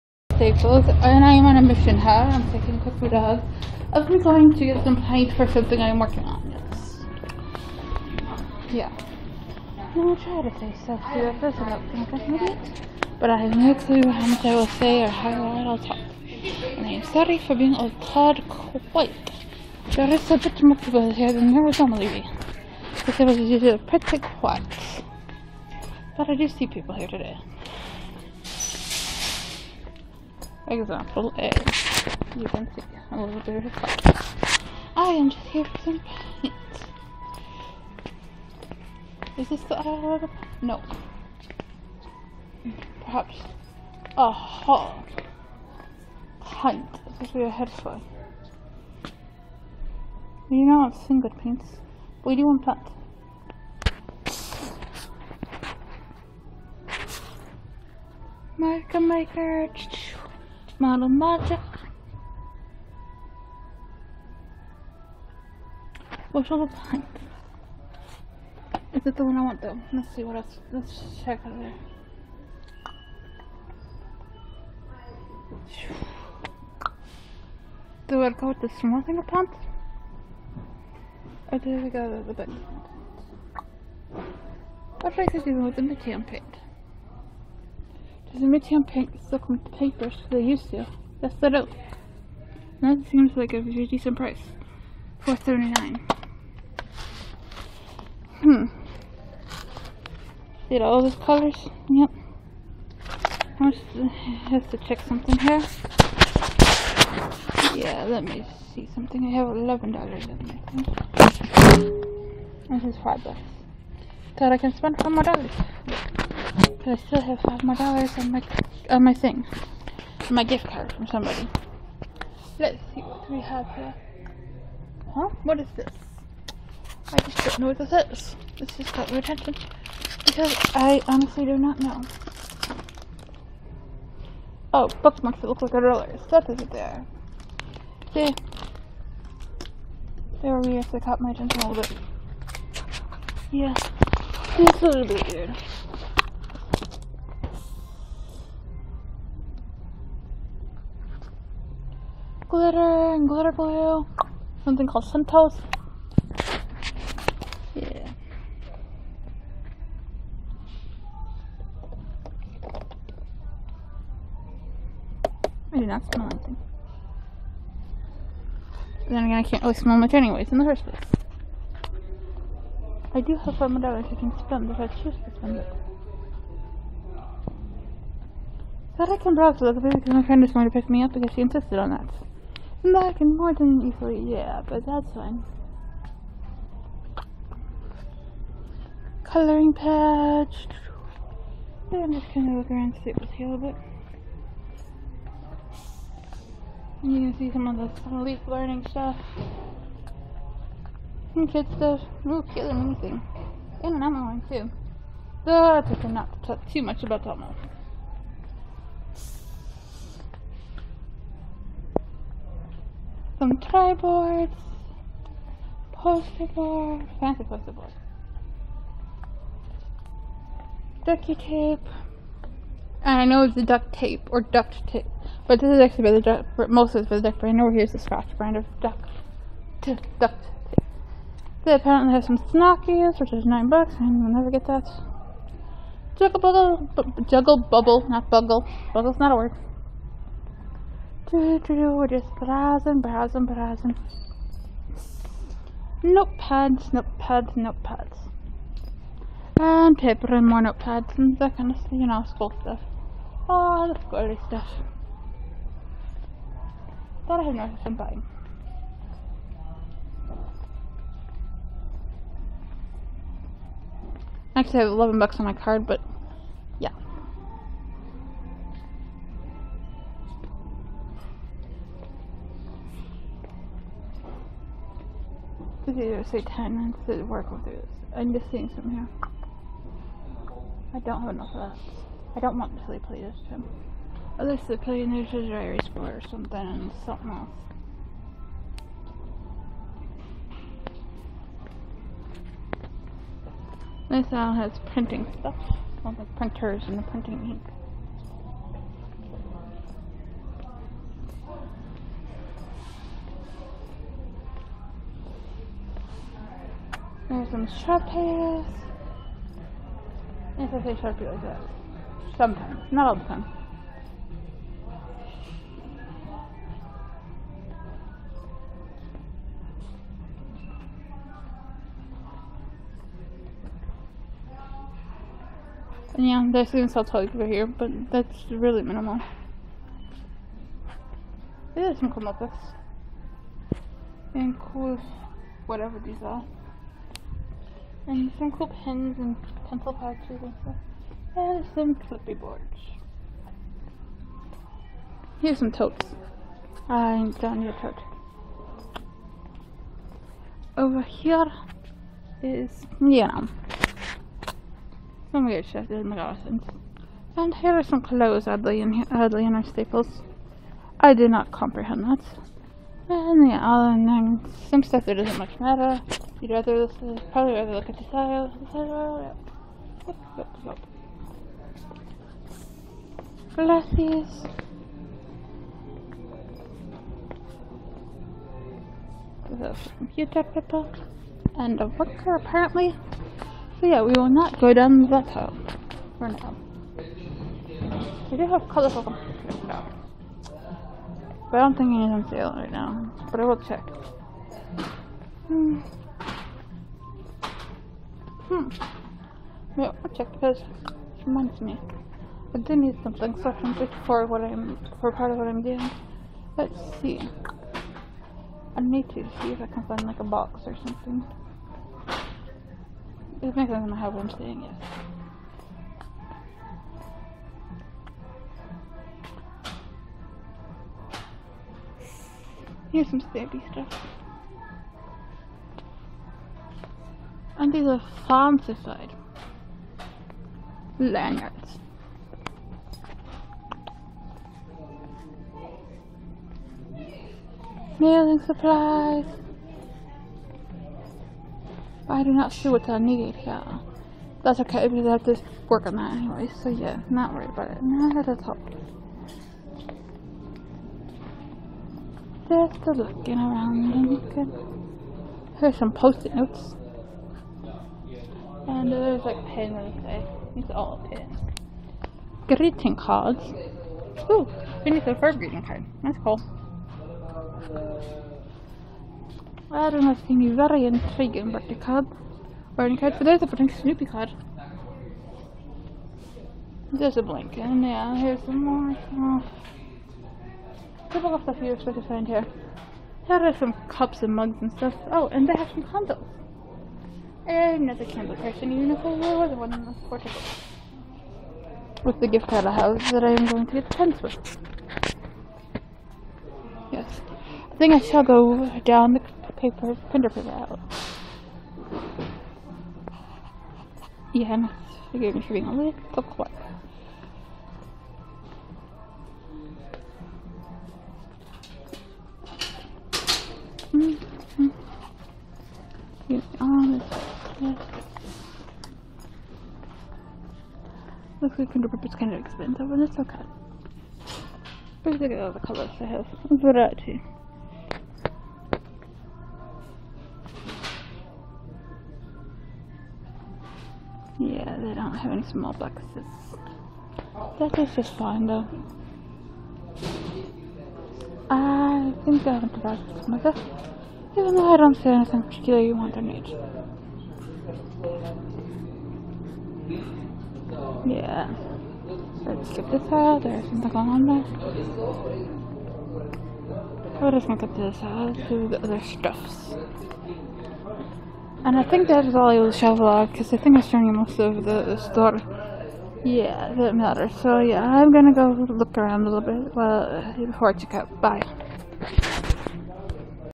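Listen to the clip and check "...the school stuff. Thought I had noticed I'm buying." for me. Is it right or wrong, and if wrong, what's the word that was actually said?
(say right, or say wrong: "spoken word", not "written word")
right.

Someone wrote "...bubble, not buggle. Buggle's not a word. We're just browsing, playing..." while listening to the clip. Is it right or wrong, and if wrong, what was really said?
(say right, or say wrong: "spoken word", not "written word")
wrong: "browsing", not "playing".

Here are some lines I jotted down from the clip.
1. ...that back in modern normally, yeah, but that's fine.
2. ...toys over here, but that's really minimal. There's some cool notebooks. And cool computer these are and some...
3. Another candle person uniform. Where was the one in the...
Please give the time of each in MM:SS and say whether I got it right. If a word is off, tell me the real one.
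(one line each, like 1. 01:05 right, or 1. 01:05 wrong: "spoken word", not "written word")
1. 03:01 wrong: "equally", not "normally"
2. 05:27 wrong: "whatever", not "computer"
3. 08:07 right.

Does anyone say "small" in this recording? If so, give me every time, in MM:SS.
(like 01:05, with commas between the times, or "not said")
01:18, 08:55.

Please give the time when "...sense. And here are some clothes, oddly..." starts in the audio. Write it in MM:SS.
05:56.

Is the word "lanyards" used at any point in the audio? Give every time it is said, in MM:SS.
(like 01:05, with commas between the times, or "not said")
07:10.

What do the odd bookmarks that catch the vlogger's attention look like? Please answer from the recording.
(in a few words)
Rollers.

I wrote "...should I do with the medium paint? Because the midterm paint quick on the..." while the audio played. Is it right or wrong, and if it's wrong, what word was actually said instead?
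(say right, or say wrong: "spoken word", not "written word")
wrong: "stuck", not "quick".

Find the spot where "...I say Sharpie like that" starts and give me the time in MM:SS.
05:10.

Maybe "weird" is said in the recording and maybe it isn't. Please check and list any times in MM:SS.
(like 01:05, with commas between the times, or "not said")
02:20, 02:25, 05:55.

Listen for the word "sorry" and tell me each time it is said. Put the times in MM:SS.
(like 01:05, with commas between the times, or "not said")
00:17.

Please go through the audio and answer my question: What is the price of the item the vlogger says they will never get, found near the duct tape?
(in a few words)
9 dollars.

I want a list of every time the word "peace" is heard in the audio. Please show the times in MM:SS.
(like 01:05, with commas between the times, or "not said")
not said.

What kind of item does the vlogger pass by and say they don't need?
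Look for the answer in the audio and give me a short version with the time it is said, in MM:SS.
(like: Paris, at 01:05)
Totes, at 05:45.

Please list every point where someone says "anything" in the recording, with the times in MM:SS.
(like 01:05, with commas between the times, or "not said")
02:46, 03:22, 06:31, 09:05.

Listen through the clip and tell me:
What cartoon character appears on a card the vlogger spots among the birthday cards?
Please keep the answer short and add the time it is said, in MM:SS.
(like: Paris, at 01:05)
Snoopy, at 07:53.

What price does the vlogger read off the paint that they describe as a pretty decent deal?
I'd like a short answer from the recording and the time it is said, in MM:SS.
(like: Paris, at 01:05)
$4.39, at 01:35.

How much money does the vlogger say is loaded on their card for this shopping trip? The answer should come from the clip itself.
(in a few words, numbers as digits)
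11 dollars.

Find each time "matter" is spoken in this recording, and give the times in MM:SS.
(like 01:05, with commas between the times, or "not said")
06:05, 09:26.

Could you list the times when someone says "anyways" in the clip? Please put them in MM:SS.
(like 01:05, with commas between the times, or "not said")
02:50, 07:26.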